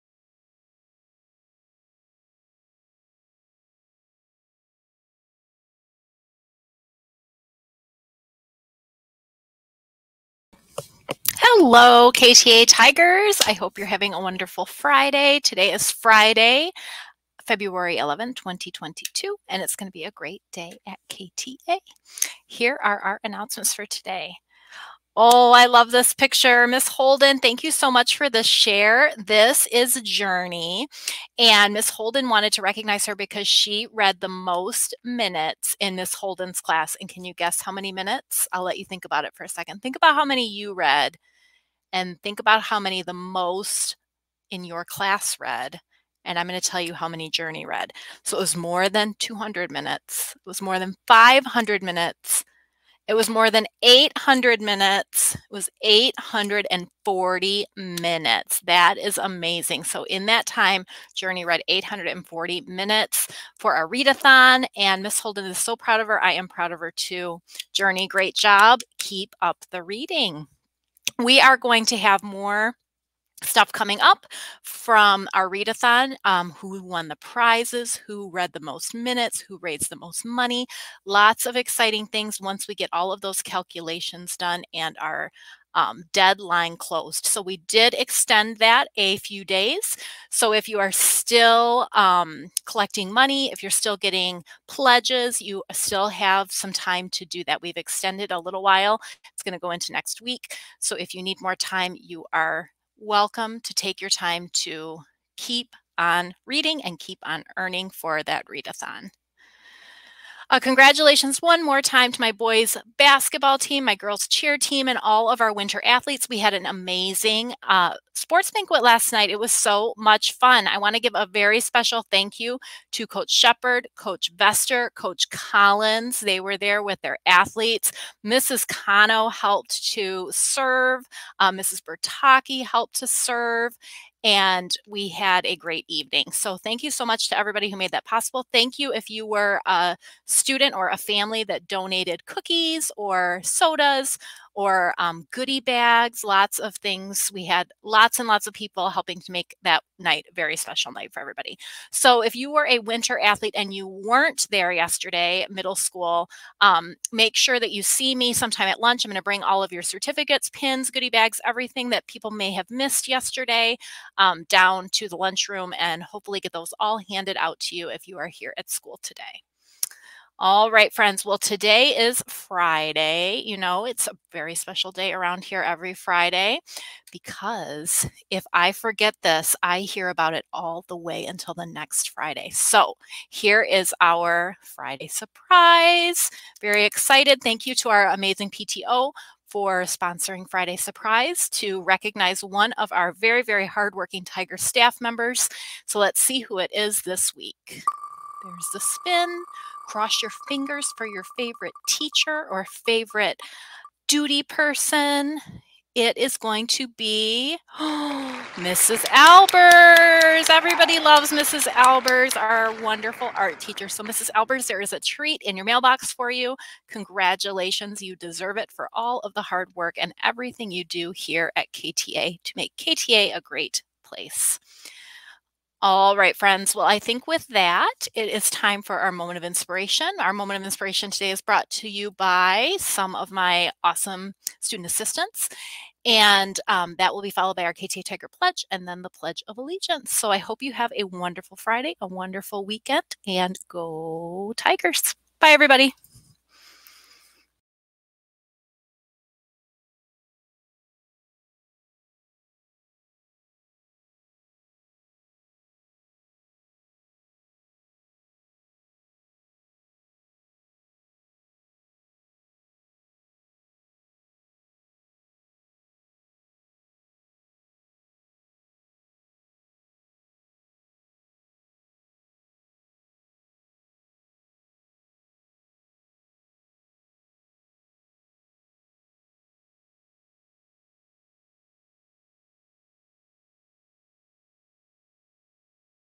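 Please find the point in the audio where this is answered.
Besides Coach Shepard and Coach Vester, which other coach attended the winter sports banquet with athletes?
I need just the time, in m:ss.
2:04.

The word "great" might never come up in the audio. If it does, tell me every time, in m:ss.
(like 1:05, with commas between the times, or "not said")
0:20, 1:08, 2:15, 3:43.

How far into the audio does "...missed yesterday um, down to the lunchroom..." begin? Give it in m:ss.
2:42.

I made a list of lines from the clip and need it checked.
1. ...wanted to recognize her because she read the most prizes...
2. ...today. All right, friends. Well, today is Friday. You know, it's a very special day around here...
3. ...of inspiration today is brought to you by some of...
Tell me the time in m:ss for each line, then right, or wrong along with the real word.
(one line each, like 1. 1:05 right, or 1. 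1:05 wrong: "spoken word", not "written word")
1. 0:32 wrong: "minutes", not "prizes"
2. 2:49 right
3. 3:50 right.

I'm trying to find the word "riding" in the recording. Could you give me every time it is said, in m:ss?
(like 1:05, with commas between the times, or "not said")
not said.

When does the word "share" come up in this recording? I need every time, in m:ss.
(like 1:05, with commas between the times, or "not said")
0:28.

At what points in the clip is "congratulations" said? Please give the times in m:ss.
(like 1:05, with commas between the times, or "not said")
1:50, 3:36.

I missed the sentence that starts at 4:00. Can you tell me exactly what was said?
So I hope you have a wonderful Friday, a wonderful weekend, and go Tigers.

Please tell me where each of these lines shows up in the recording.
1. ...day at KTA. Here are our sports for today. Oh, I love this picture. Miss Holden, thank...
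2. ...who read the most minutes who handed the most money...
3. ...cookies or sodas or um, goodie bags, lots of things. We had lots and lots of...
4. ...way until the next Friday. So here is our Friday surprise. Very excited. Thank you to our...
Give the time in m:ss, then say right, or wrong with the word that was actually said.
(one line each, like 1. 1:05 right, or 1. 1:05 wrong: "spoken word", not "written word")
1. 0:20 wrong: "announcements", not "sports"
2. 1:18 wrong: "raised", not "handed"
3. 2:22 right
4. 3:00 right.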